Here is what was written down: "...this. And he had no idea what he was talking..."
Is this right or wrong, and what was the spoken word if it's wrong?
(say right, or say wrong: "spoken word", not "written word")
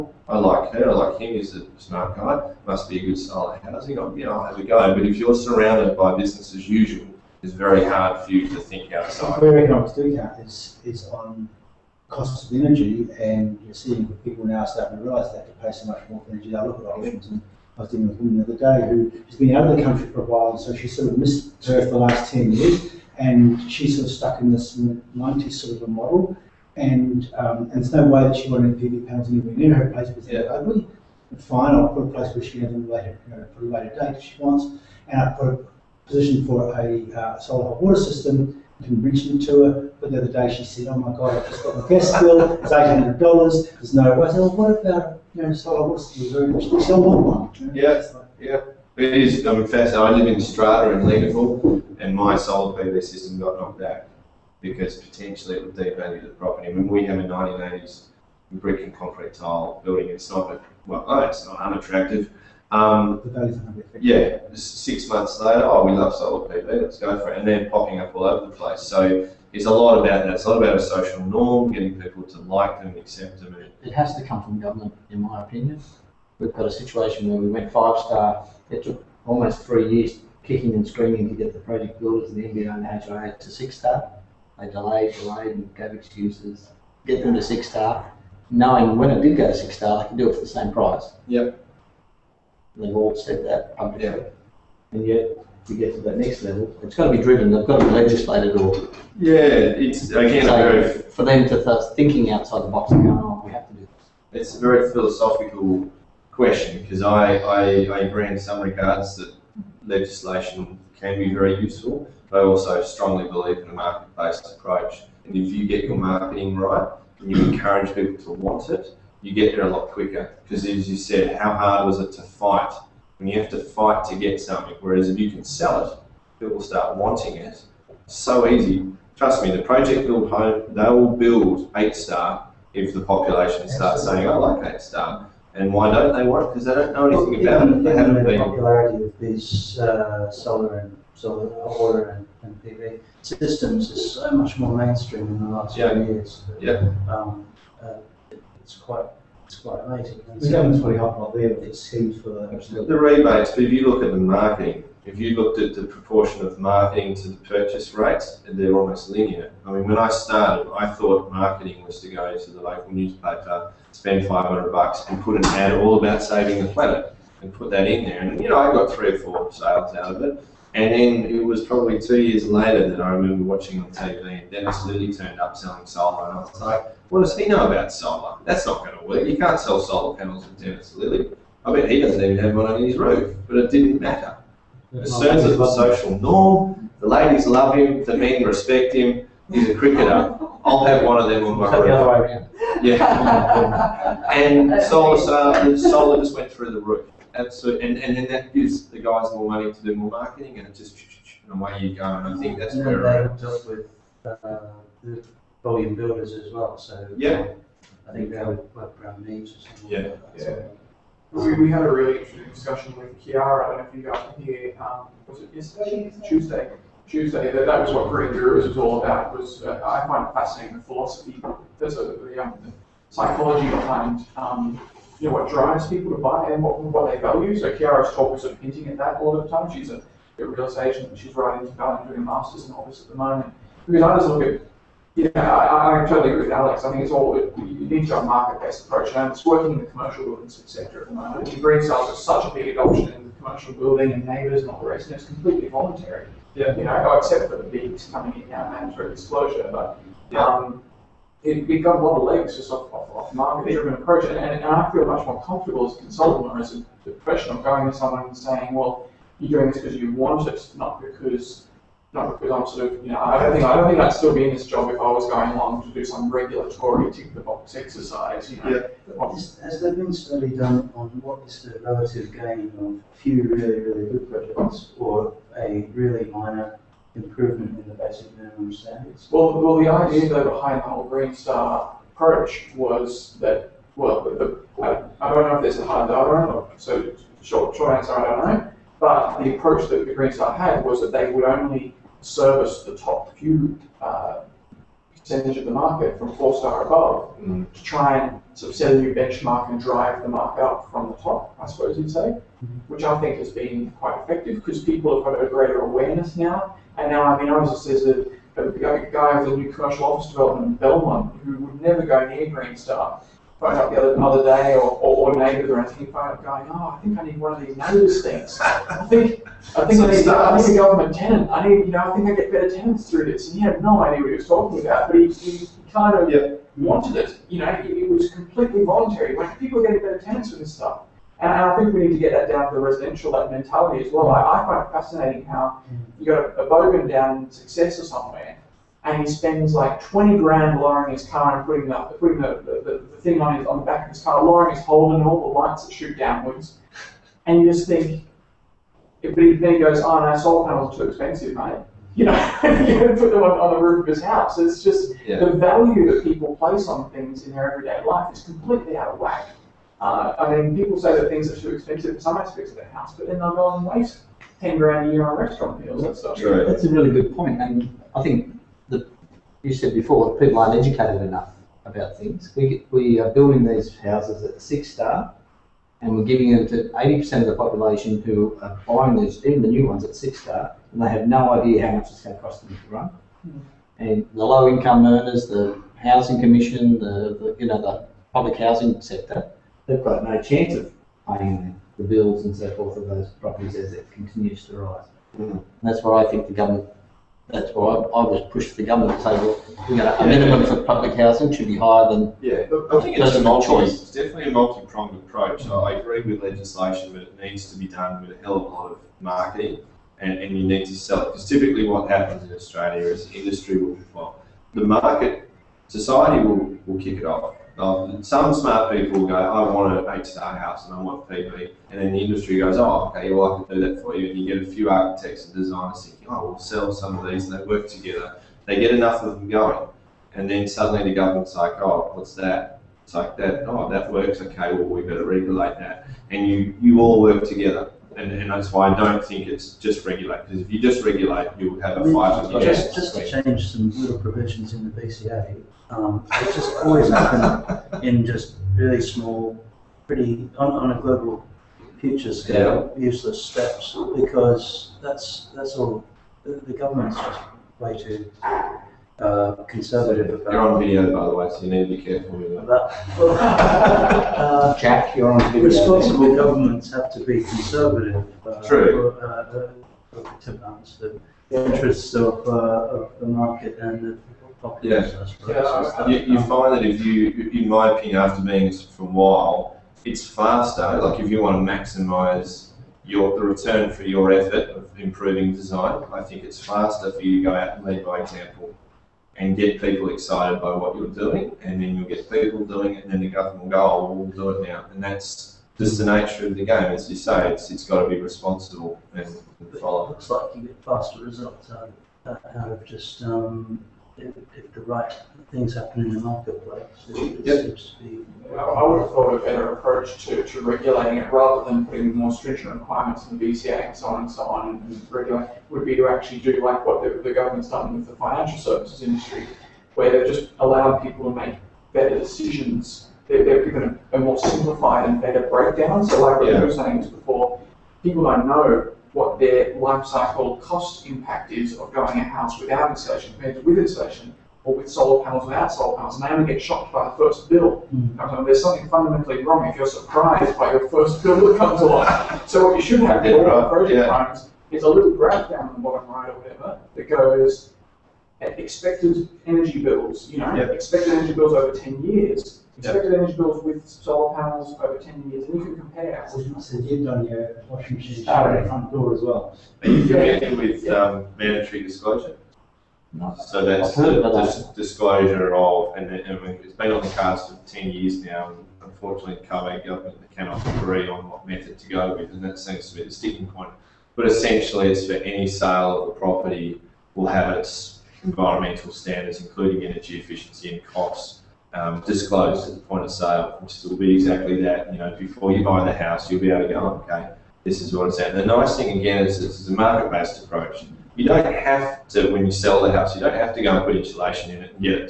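right.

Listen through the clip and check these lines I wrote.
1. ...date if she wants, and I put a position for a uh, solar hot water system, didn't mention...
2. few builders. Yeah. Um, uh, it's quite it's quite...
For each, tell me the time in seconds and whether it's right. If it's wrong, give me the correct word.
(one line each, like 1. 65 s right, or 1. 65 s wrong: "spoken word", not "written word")
1. 33 s right
2. 145 s wrong: "years", not "builders".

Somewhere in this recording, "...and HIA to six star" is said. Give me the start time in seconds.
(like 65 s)
82 s.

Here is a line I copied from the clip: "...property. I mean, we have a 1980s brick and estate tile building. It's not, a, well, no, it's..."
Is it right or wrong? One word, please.
wrong.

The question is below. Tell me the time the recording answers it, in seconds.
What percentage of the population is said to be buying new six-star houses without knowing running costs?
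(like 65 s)
376 s.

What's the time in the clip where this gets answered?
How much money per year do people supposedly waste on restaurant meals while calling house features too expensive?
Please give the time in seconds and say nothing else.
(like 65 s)
364 s.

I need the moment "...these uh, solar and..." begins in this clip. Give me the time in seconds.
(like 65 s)
139 s.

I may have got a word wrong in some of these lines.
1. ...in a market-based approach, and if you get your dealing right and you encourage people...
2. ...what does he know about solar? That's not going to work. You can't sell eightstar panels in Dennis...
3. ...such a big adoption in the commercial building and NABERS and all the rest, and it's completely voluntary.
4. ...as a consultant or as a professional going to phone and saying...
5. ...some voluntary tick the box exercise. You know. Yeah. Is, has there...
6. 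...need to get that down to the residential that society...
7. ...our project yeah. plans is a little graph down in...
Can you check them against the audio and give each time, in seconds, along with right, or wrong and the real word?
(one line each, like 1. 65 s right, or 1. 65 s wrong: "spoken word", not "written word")
1. 113 s wrong: "marketing", not "dealing"
2. 177 s wrong: "solar", not "eightstar"
3. 242 s right
4. 255 s wrong: "someone", not "phone"
5. 266 s wrong: "regulatory", not "voluntary"
6. 331 s wrong: "mentality", not "society"
7. 543 s right.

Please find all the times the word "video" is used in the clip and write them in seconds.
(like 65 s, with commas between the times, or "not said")
460 s, 465 s.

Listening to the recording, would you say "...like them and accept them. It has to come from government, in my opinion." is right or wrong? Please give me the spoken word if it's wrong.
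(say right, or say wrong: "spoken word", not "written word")
right.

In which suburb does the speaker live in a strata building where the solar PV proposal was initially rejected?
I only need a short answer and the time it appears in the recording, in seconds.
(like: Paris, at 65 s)
Leederville, at 51 s.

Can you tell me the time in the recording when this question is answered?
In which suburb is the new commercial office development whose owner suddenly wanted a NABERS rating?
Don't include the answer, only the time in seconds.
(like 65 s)
310 s.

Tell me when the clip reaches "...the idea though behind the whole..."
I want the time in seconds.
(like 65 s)
279 s.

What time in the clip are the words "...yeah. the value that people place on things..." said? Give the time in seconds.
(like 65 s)
355 s.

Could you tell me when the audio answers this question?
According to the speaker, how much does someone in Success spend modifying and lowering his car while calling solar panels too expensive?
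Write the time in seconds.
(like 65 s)
340 s.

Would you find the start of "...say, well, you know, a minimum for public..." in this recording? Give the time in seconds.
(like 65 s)
399 s.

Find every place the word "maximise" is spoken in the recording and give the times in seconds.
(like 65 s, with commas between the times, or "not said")
481 s.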